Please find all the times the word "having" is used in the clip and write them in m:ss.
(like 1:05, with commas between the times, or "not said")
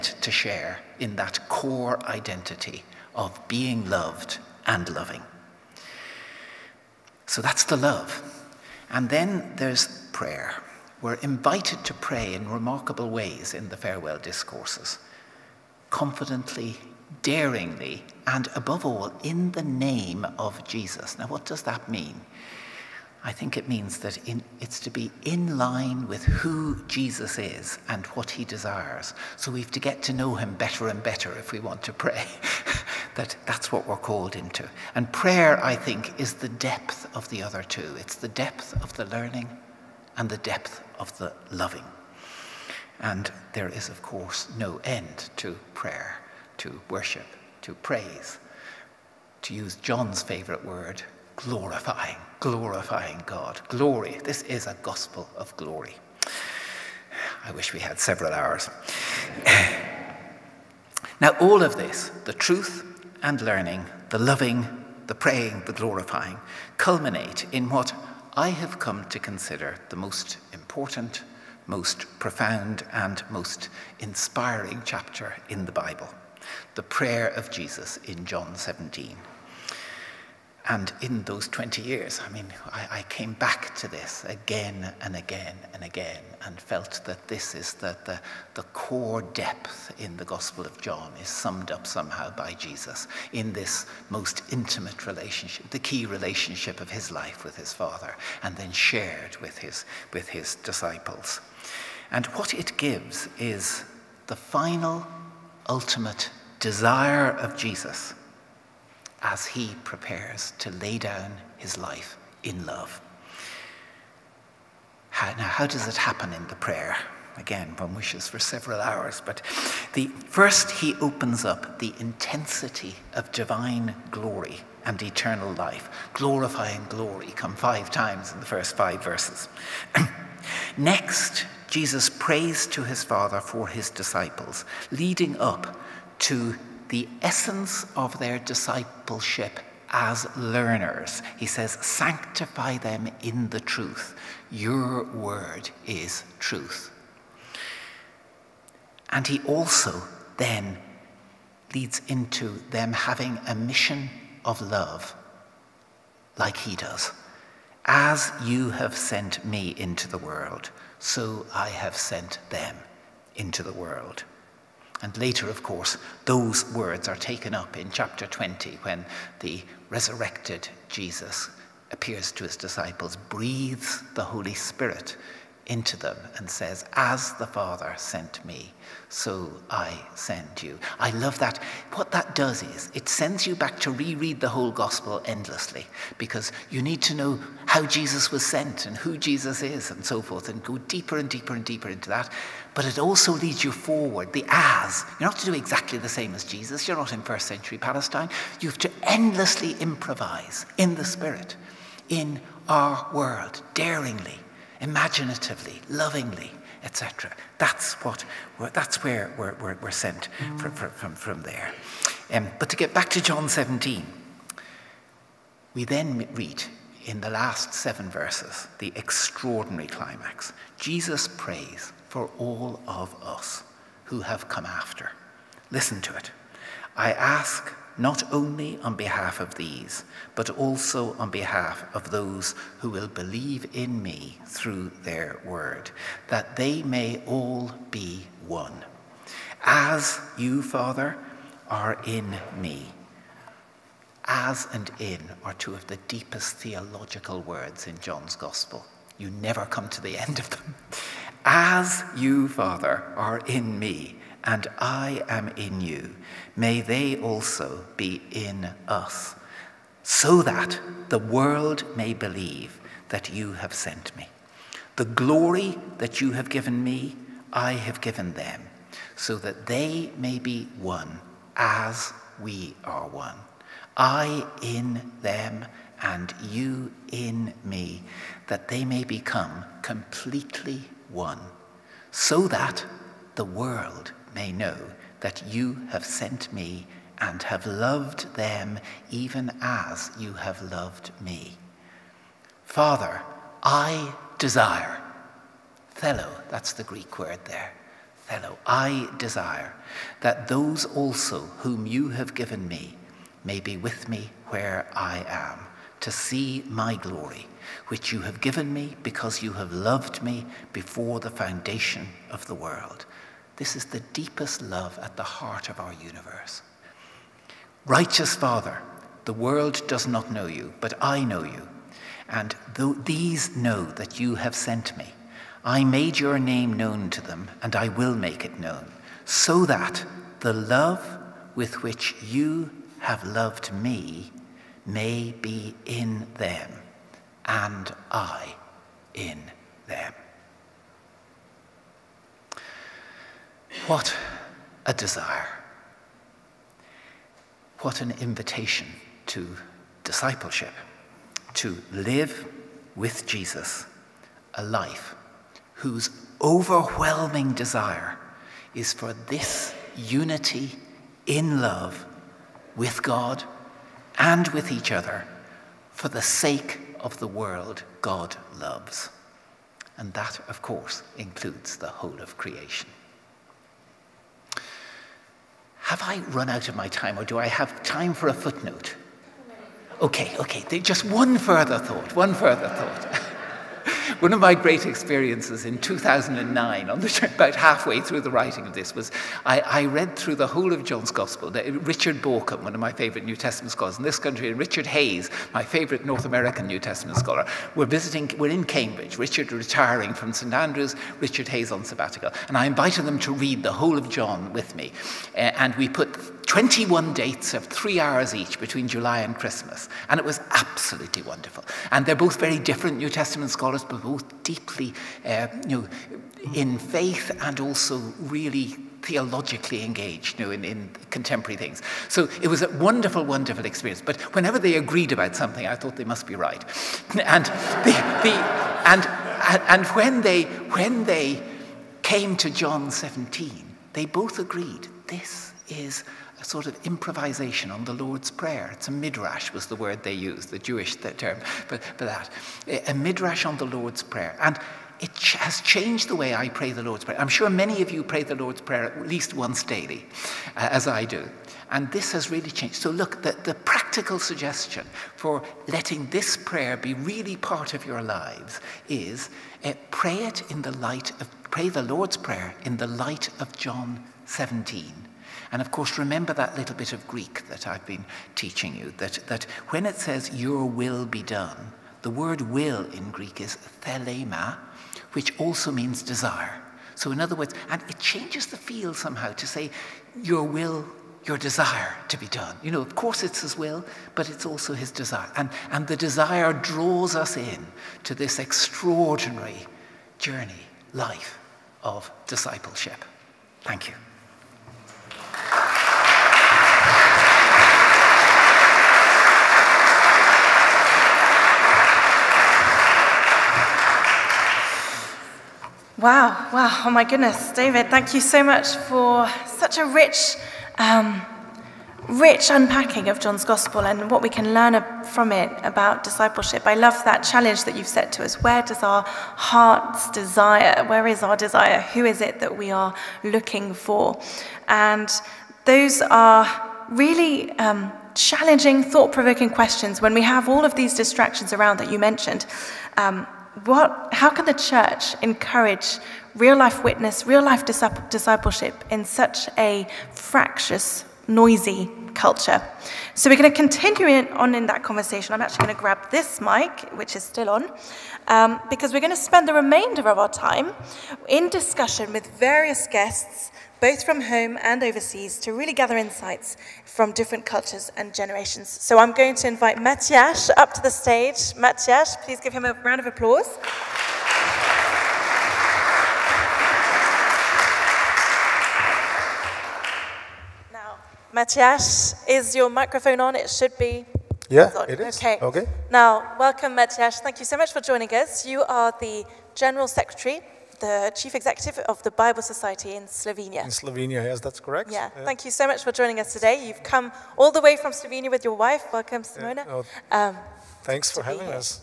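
2:32, 9:51.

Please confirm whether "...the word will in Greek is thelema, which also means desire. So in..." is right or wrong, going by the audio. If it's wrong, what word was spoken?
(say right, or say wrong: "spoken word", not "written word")
right.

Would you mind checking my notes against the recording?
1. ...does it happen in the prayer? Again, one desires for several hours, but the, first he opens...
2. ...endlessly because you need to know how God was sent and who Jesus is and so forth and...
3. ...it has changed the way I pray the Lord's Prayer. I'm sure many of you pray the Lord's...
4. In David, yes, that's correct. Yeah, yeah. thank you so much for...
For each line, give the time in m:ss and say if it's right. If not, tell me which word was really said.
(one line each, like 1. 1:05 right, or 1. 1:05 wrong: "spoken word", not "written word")
1. 1:55 wrong: "wishes", not "desires"
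2. 3:05 wrong: "Jesus", not "God"
3. 7:24 right
4. 9:43 wrong: "Slovenia", not "David".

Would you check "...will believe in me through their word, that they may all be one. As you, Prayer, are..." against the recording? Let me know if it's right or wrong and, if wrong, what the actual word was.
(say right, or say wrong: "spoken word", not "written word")
wrong: "Father", not "Prayer".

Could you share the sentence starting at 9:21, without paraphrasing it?
Matthias, please give him a round of applause.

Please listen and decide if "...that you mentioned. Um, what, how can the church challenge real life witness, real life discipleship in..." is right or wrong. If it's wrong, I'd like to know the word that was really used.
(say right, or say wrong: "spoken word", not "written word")
wrong: "encourage", not "challenge".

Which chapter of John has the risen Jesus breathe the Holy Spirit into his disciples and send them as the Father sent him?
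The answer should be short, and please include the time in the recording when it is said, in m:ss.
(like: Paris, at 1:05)
Chapter 20, at 2:47.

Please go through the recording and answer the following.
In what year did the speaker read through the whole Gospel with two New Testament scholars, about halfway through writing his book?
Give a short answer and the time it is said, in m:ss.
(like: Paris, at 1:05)
2009, at 6:25.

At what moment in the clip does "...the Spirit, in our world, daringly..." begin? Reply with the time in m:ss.
3:20.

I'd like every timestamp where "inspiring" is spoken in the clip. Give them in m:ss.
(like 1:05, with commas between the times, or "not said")
1:13.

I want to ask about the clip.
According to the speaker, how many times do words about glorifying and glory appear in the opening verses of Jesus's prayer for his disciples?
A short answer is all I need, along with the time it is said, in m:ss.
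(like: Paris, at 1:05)
5, at 2:07.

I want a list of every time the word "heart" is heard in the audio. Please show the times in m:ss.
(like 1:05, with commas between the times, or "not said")
5:15, 8:39.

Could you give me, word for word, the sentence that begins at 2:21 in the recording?
He says, Sanctify them in the truth.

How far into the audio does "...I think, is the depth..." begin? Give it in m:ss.
0:35.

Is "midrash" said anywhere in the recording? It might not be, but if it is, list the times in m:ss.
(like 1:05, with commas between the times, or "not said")
7:18, 7:22.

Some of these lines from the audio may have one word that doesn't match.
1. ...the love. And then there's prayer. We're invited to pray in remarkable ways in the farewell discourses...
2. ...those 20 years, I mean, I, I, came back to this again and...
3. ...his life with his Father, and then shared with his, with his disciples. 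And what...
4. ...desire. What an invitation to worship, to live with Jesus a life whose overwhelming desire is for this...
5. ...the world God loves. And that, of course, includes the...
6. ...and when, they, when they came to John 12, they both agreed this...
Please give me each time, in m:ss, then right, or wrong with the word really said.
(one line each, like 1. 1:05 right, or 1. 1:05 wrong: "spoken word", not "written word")
1. 0:07 right
2. 1:21 right
3. 1:36 right
4. 5:44 wrong: "discipleship", not "worship"
5. 6:07 right
6. 7:09 wrong: "17", not "12".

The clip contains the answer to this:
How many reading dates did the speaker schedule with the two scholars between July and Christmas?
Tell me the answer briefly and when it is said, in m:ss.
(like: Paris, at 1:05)
21, at 6:46.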